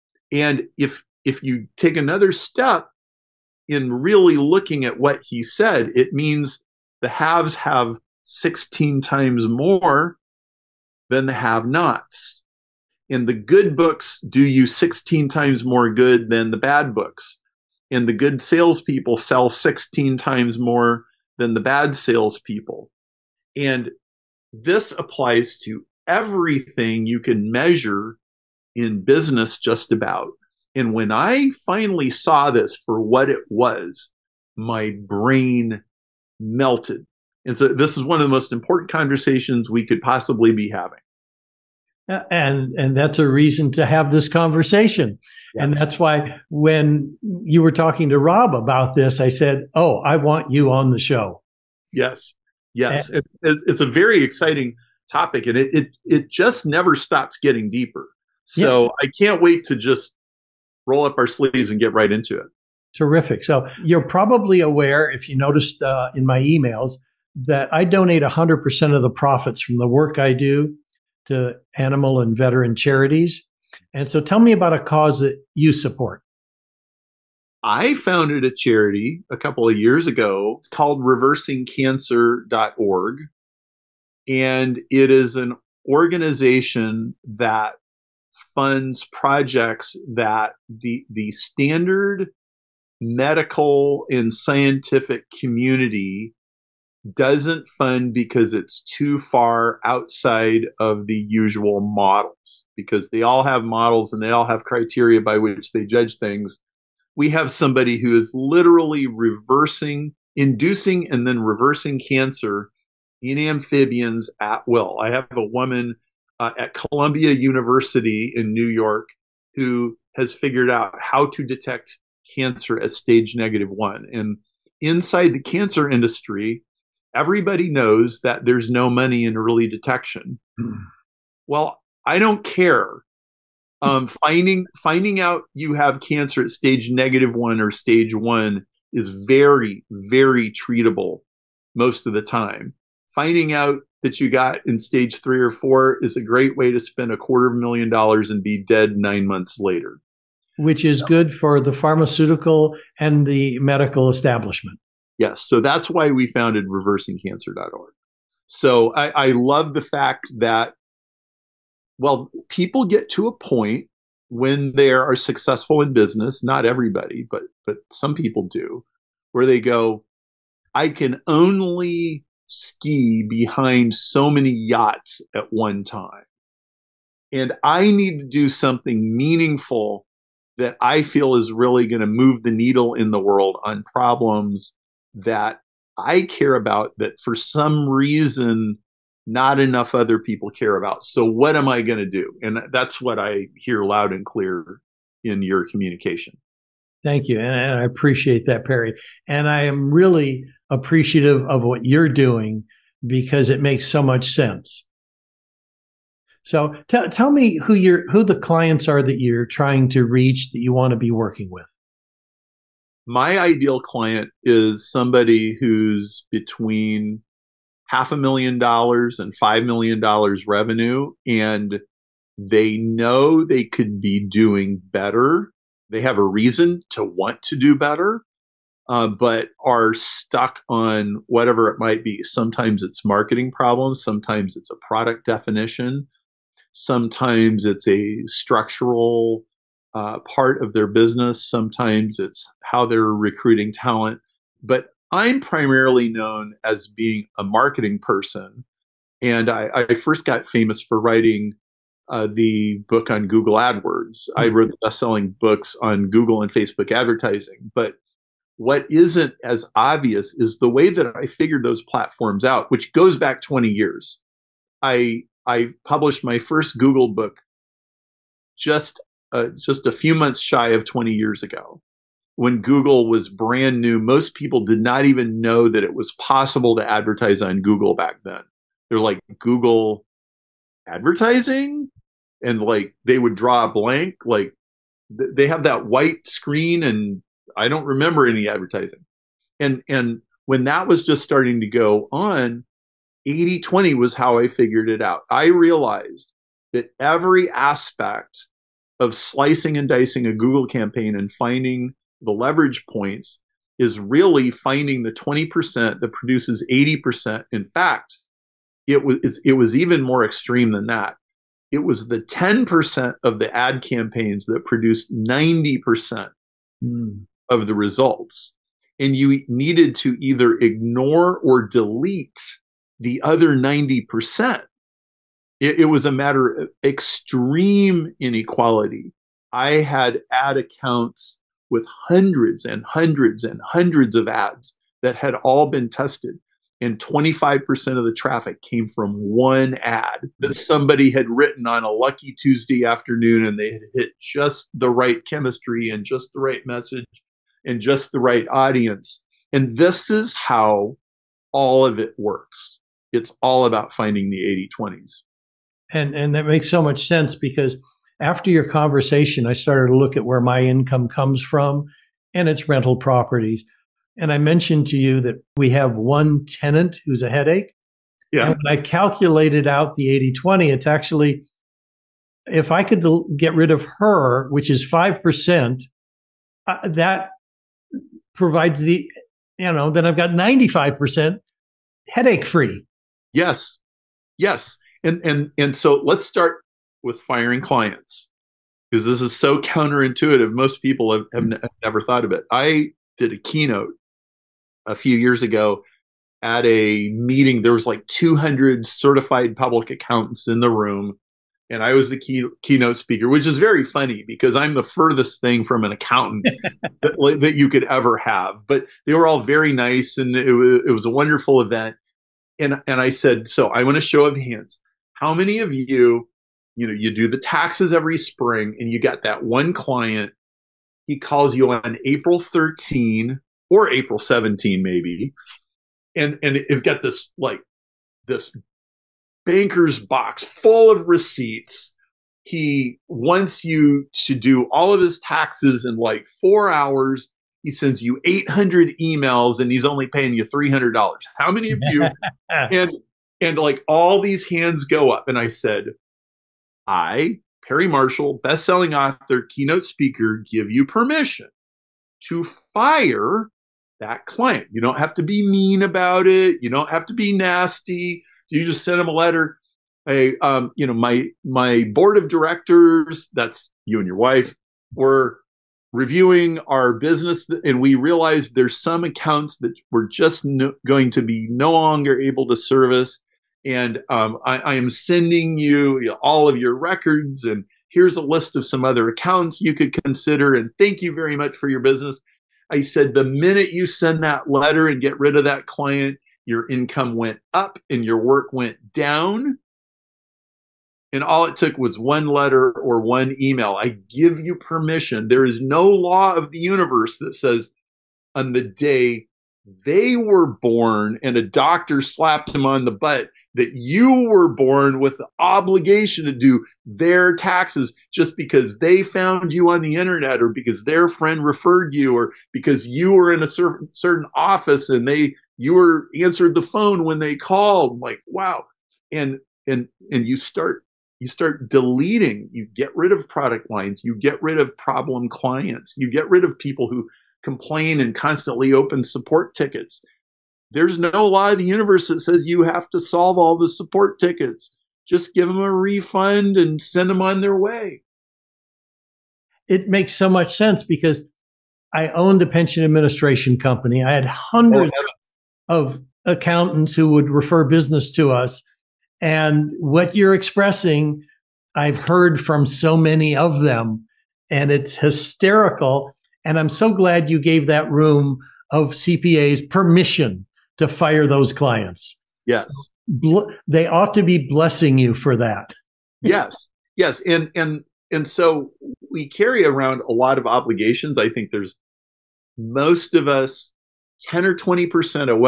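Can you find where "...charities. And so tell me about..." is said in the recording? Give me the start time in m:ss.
1:12.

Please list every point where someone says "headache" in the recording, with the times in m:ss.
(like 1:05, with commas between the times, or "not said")
6:07, 6:22.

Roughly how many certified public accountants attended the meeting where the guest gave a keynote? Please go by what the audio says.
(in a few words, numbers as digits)
200.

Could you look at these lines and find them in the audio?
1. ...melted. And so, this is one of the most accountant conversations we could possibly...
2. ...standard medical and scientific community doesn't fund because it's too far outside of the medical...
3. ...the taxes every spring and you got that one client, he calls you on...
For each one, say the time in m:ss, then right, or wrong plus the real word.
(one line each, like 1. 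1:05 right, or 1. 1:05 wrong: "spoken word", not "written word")
1. 0:36 wrong: "important", not "accountant"
2. 1:31 wrong: "usual", not "medical"
3. 6:57 right.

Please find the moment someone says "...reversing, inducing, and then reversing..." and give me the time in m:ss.
1:49.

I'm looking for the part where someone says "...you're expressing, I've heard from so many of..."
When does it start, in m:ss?
9:10.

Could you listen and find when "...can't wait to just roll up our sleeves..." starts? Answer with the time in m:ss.
0:59.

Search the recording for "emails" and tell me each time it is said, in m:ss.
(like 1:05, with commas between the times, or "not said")
1:06, 7:19, 8:13.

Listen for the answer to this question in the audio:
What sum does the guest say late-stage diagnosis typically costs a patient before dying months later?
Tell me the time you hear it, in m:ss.
2:27.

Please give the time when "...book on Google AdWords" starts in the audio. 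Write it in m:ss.
4:12.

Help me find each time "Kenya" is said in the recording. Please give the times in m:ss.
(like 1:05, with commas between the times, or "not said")
not said.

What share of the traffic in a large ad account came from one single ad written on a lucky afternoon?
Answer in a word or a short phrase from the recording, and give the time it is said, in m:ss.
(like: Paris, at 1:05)
25%, at 5:36.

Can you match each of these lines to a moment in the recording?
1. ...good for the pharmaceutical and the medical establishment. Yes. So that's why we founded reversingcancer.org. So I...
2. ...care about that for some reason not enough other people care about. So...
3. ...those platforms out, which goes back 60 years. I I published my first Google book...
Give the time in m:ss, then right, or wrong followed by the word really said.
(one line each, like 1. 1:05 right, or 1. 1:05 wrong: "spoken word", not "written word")
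1. 2:31 right
2. 3:06 right
3. 4:21 wrong: "20", not "60".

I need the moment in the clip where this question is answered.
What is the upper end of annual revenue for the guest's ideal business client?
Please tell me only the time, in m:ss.
3:39.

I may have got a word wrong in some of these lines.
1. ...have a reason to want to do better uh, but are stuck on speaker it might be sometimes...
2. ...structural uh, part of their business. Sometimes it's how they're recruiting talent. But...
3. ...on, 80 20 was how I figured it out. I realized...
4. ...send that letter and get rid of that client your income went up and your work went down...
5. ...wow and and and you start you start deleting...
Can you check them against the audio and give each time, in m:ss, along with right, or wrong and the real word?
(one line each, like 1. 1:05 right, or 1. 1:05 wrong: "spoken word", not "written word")
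1. 3:46 wrong: "whatever", not "speaker"
2. 3:58 right
3. 4:52 right
4. 8:03 right
5. 8:38 right.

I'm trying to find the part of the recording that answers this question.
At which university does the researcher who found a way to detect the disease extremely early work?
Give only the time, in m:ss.
1:56.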